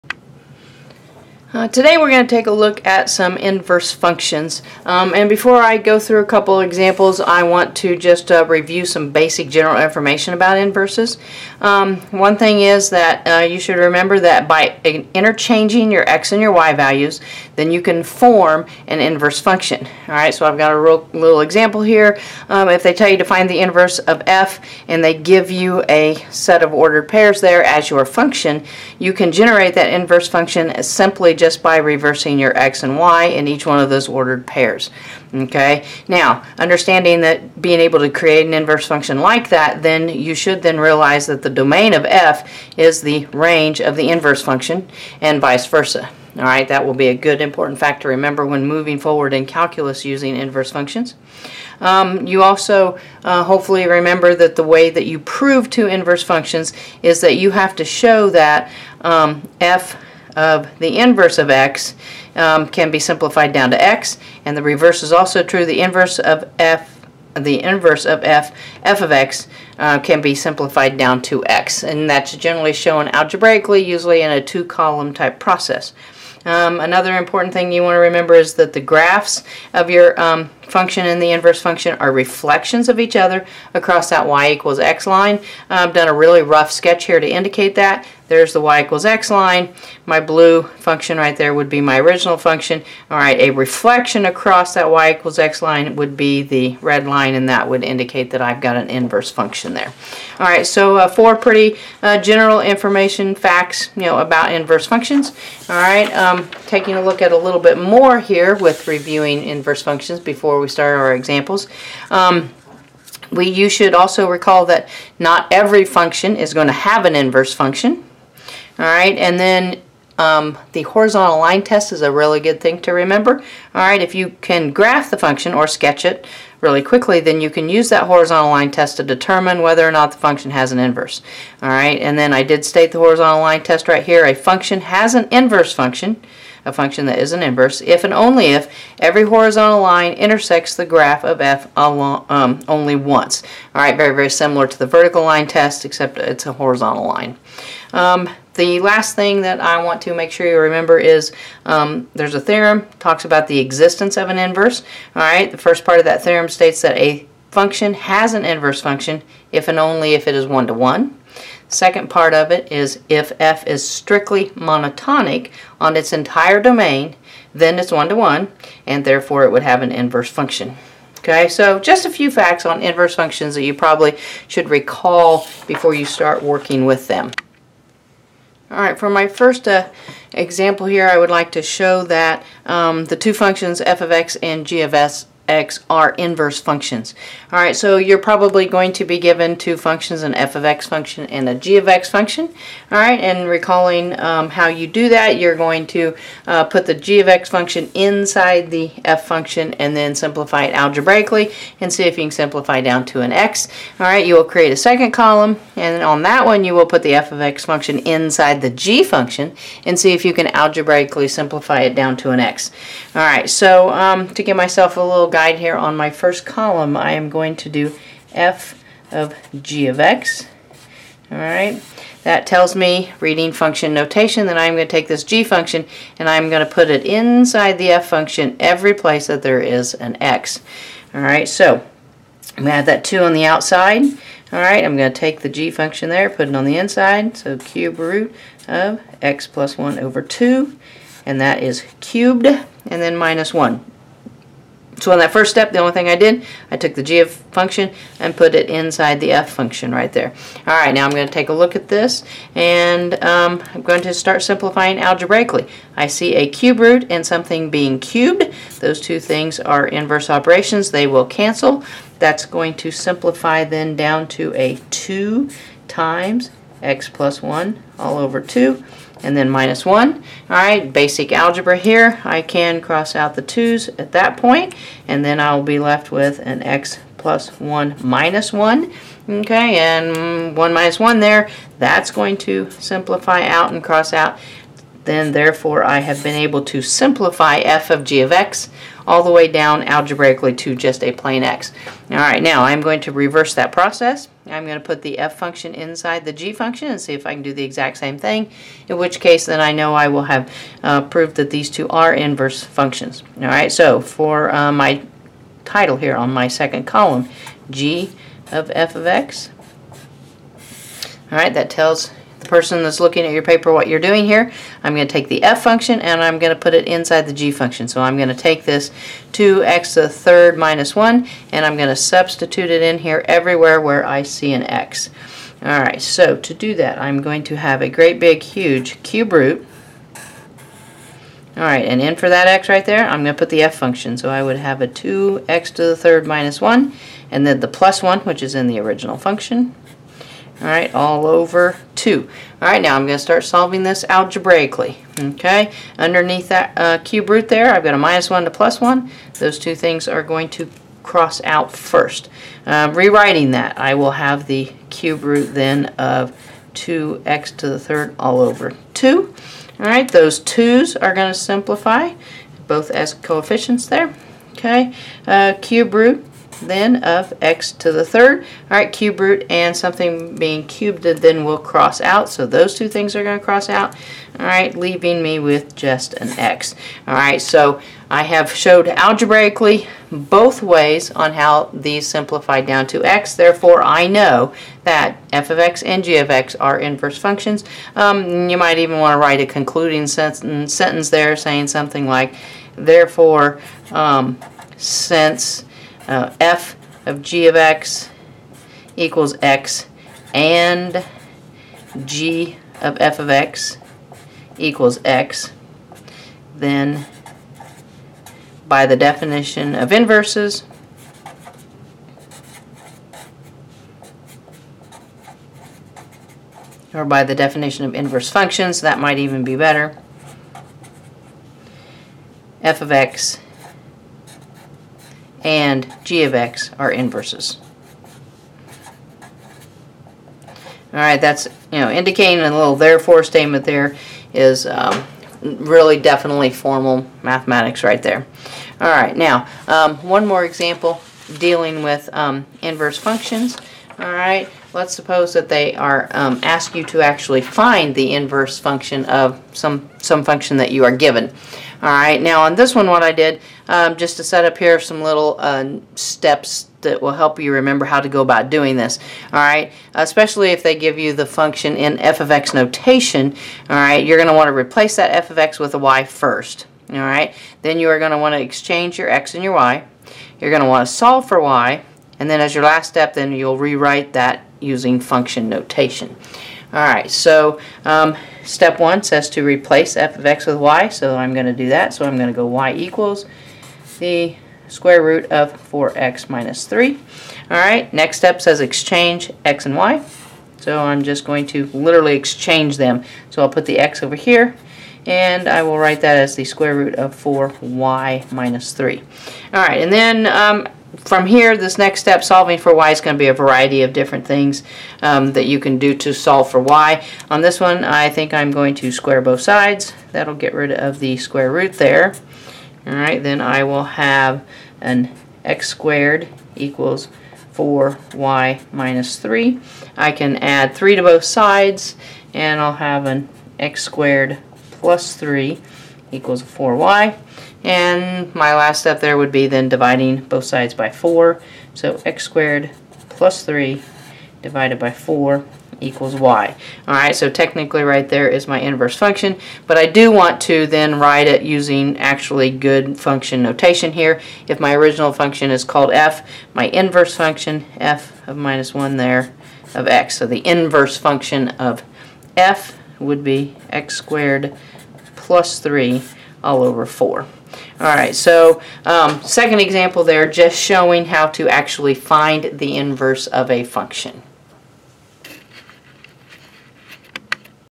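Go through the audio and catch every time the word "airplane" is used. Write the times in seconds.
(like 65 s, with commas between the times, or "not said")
not said.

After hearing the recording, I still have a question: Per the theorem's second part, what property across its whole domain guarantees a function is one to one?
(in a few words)
Strictly monotonic.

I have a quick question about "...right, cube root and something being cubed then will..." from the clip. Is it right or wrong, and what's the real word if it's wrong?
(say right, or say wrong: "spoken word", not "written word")
right.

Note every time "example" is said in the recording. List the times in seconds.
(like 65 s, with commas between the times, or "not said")
6 s, 21 s, 111 s, 180 s, 440 s, 559 s.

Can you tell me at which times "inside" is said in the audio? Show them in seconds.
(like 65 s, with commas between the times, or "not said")
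197 s, 207 s, 227 s, 236 s, 248 s, 295 s, 316 s.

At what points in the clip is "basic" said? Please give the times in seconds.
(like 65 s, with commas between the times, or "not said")
9 s, 270 s.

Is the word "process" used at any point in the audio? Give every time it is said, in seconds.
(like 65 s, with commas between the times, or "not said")
75 s, 293 s.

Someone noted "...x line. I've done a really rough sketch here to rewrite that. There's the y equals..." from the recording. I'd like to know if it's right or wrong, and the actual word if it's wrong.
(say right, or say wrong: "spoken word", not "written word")
wrong: "indicate", not "rewrite".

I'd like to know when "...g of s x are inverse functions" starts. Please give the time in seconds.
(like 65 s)
184 s.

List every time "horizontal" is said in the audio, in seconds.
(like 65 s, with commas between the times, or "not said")
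120 s, 128 s, 132 s, 139 s, 146 s.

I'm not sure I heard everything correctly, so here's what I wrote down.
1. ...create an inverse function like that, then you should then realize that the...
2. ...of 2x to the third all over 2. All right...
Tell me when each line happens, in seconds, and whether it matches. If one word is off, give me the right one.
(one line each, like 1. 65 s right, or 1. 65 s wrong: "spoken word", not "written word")
1. 38 s right
2. 355 s right.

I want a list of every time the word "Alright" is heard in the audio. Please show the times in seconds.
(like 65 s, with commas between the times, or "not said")
20 s, 325 s, 557 s.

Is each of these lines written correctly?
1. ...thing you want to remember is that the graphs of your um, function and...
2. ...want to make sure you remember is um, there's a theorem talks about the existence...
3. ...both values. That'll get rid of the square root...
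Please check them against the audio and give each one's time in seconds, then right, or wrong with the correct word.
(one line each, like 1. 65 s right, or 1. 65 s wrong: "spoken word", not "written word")
1. 77 s right
2. 149 s right
3. 509 s wrong: "sides", not "values".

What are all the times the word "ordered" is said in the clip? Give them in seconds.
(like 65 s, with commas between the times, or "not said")
26 s, 34 s.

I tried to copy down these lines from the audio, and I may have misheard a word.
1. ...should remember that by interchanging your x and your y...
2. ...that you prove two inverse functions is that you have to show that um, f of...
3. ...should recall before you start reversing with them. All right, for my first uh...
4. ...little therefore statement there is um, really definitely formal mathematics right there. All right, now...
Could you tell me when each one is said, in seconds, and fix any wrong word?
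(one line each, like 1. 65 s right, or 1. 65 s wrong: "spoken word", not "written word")
1. 13 s right
2. 54 s right
3. 174 s wrong: "working", not "reversing"
4. 432 s right.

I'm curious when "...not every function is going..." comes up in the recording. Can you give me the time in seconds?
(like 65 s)
115 s.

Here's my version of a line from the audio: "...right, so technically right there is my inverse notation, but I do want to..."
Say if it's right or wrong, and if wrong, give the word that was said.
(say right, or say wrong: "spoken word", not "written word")
wrong: "function", not "notation".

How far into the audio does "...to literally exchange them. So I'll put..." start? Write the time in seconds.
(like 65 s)
491 s.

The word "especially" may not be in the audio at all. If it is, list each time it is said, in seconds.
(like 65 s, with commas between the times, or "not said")
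459 s.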